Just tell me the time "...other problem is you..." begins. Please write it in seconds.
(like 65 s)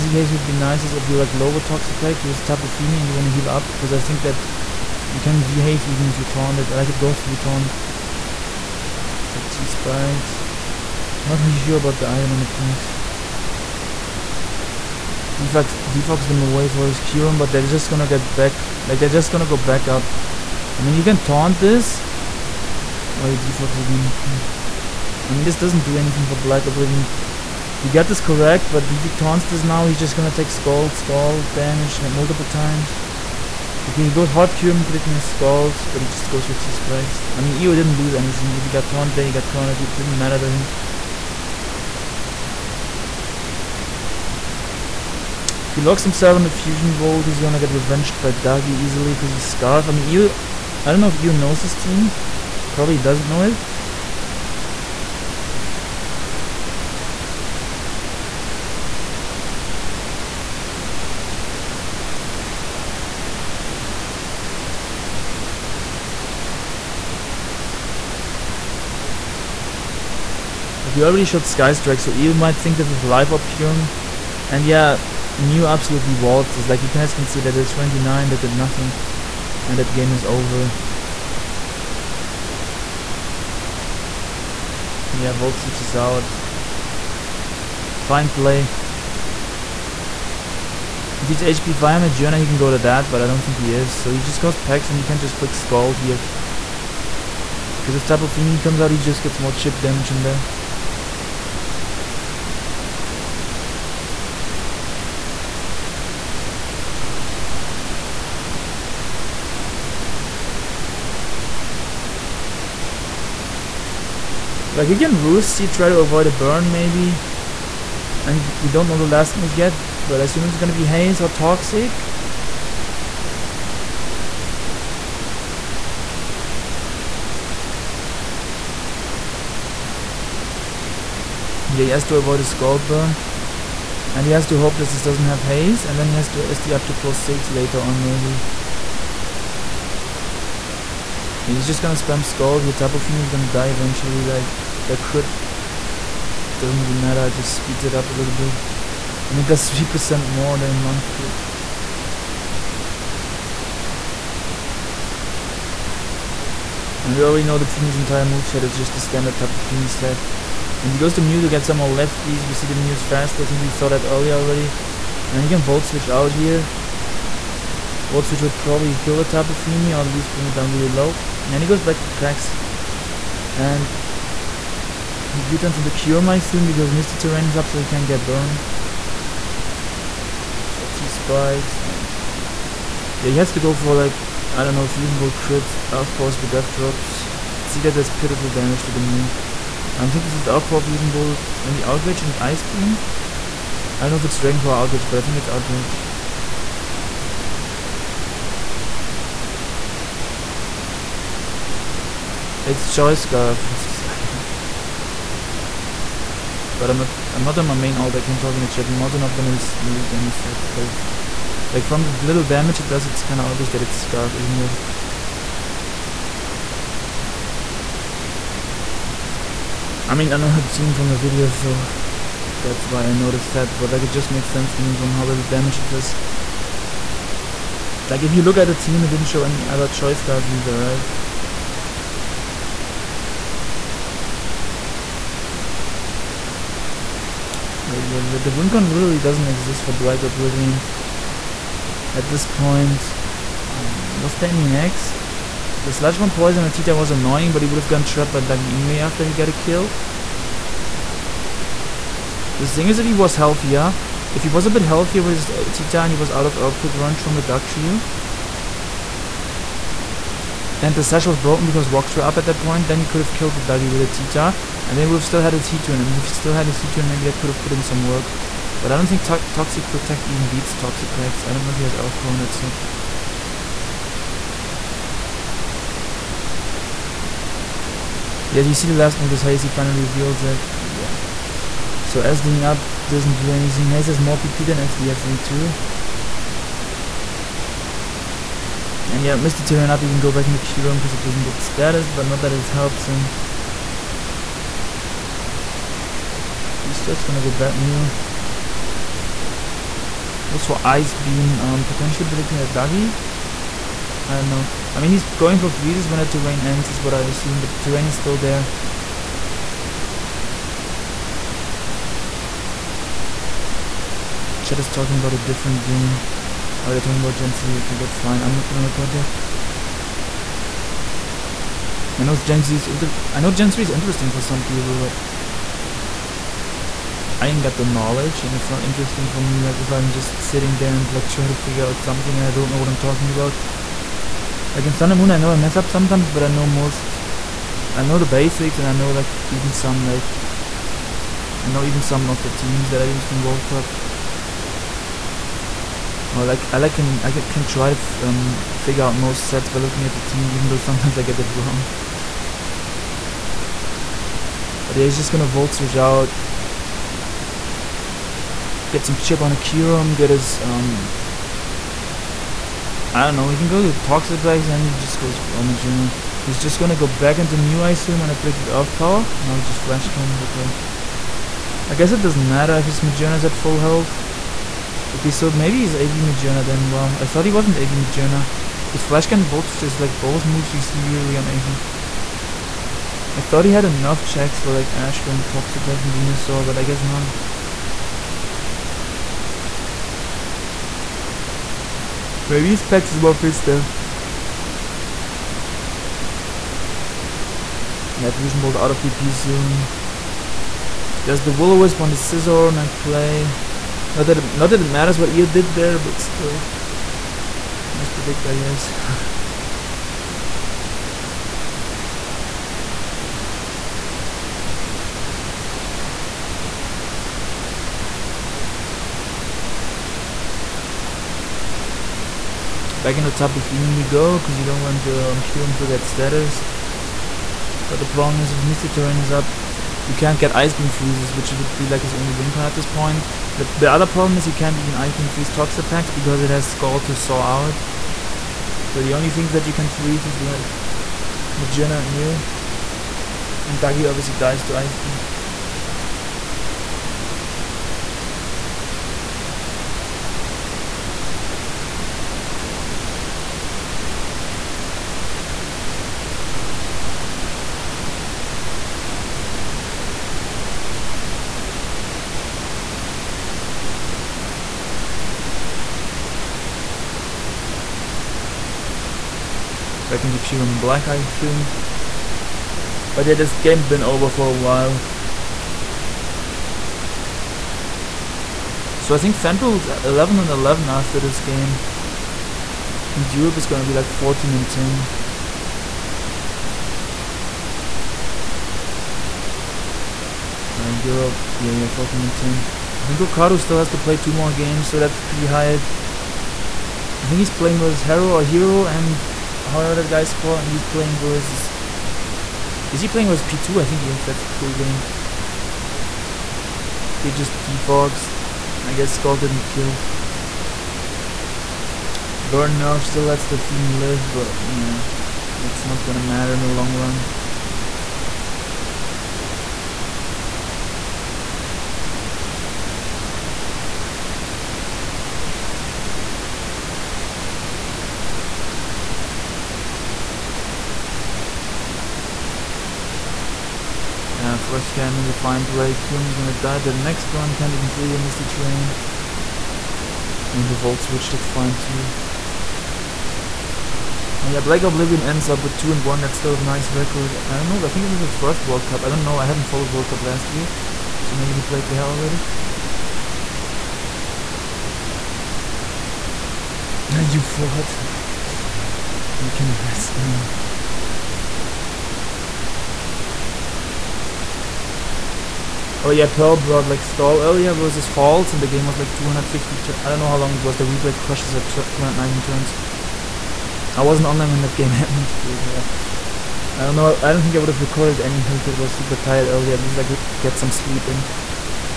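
433 s.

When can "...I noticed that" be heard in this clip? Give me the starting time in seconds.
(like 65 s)
223 s.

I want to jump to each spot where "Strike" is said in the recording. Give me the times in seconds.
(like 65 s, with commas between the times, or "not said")
71 s.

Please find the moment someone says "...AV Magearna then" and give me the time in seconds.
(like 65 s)
375 s.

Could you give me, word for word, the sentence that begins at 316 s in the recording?
Oh, they're talking about Gen 3.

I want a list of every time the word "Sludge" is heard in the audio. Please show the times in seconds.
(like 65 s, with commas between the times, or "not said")
245 s.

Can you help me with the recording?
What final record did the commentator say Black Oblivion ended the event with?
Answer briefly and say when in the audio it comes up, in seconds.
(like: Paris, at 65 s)
2 and 1, at 545 s.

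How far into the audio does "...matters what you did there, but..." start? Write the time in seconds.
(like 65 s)
404 s.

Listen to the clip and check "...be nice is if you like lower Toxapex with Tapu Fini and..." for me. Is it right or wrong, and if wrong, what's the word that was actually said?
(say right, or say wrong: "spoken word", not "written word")
right.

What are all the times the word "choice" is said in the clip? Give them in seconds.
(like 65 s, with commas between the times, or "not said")
229 s.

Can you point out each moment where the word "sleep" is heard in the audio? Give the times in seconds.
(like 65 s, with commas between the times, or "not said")
580 s.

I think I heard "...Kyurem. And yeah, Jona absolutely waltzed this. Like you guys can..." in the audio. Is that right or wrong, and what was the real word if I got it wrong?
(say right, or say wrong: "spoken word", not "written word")
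wrong: "Mew", not "Jona".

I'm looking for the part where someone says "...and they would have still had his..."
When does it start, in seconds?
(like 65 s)
264 s.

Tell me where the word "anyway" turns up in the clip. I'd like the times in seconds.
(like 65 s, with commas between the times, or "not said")
248 s, 578 s.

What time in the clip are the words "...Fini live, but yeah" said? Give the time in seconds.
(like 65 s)
513 s.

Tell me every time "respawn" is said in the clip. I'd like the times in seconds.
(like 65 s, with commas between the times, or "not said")
not said.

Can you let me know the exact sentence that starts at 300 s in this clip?
Goes for Ice Beam, um, potentially predicting a Duggy.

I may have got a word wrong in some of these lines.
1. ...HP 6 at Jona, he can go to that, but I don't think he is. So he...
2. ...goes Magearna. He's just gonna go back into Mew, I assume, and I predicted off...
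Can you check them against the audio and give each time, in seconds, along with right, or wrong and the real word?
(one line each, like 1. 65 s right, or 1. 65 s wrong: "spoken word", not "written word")
1. 91 s wrong: "5", not "6"
2. 365 s right.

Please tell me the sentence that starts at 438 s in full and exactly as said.
So the only things that you can freeze is like Magearna and Mew.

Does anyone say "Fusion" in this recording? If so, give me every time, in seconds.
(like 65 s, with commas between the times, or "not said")
46 s, 184 s, 190 s, 398 s.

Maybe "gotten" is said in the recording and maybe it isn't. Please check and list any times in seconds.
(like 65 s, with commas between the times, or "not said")
247 s.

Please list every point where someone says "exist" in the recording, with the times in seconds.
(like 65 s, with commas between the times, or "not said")
239 s.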